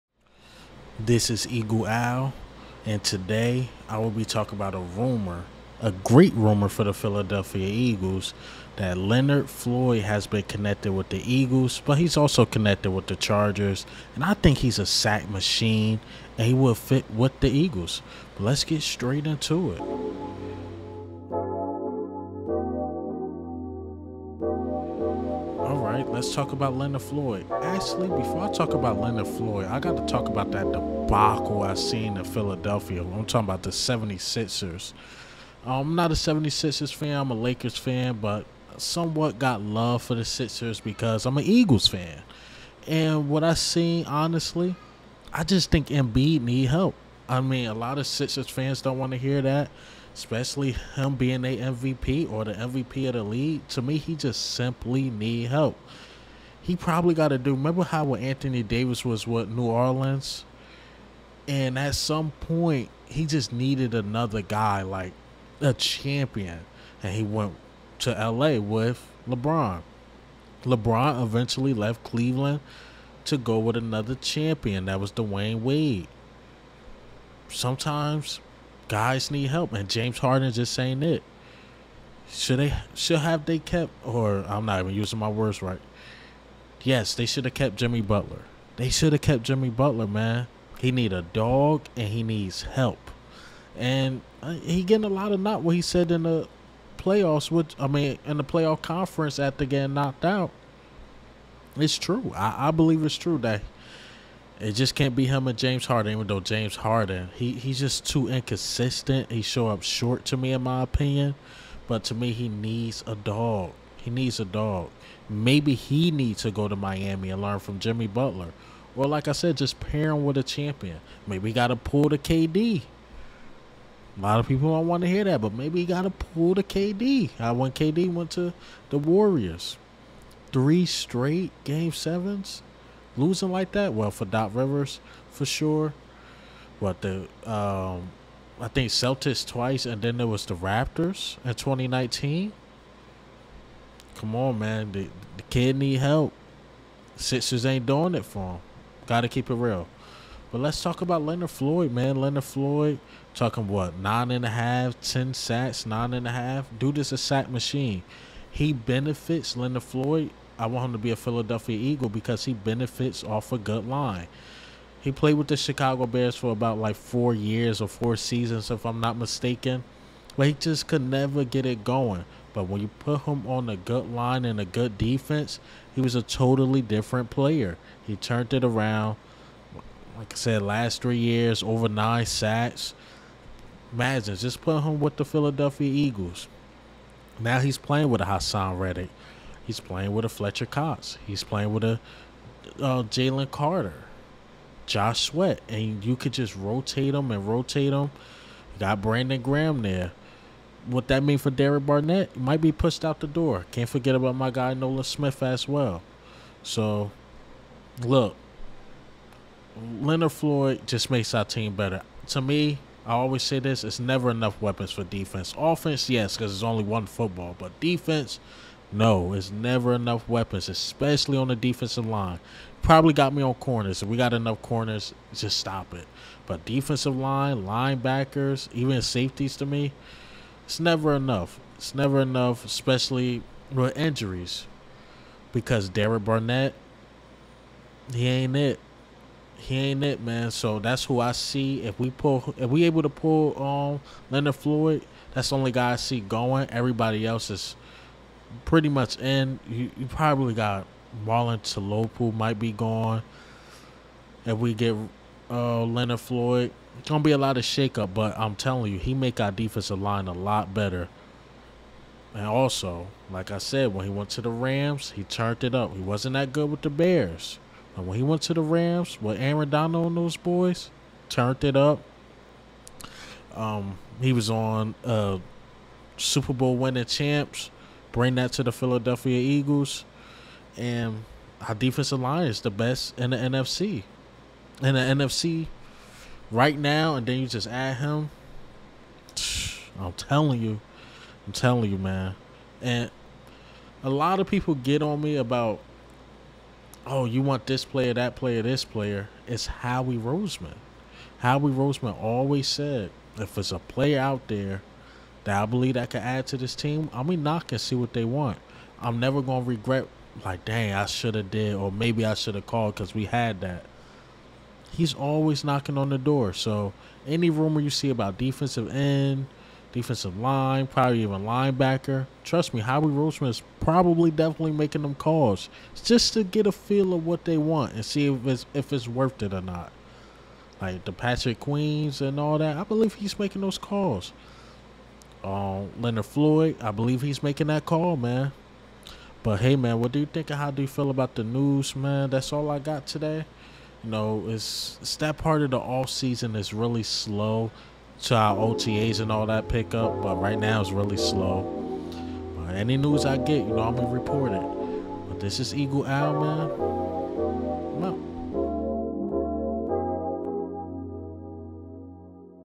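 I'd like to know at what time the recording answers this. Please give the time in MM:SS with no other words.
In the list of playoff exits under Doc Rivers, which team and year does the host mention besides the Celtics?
02:20.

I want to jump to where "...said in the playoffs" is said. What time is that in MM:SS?
01:35.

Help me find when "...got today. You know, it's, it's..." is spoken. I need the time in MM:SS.
05:42.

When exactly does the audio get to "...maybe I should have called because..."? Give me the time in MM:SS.
05:11.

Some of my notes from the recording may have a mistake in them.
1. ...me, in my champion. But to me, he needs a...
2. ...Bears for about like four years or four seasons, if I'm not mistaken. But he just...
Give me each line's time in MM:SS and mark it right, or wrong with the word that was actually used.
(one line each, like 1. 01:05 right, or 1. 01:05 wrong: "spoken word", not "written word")
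1. 01:50 wrong: "opinion", not "champion"
2. 02:46 right.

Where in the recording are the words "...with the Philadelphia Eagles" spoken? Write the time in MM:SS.
03:04.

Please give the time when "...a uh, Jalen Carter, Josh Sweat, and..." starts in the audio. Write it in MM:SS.
03:11.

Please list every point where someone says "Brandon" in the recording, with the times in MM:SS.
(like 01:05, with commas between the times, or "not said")
03:19.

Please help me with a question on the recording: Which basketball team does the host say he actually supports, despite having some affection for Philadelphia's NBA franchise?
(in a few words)
Lakers.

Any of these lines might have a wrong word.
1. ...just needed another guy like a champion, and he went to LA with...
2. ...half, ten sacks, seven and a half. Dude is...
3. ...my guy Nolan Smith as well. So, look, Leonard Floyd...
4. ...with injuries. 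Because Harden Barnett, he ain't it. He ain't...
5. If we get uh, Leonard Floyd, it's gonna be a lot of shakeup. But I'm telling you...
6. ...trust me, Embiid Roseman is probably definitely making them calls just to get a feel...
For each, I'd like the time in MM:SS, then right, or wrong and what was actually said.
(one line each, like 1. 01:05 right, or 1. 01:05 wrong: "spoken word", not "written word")
1. 01:03 right
2. 02:34 wrong: "nine", not "seven"
3. 03:24 right
4. 03:53 wrong: "Derek", not "Harden"
5. 04:14 right
6. 05:22 wrong: "Howie", not "Embiid".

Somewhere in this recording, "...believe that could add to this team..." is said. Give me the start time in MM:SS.
05:05.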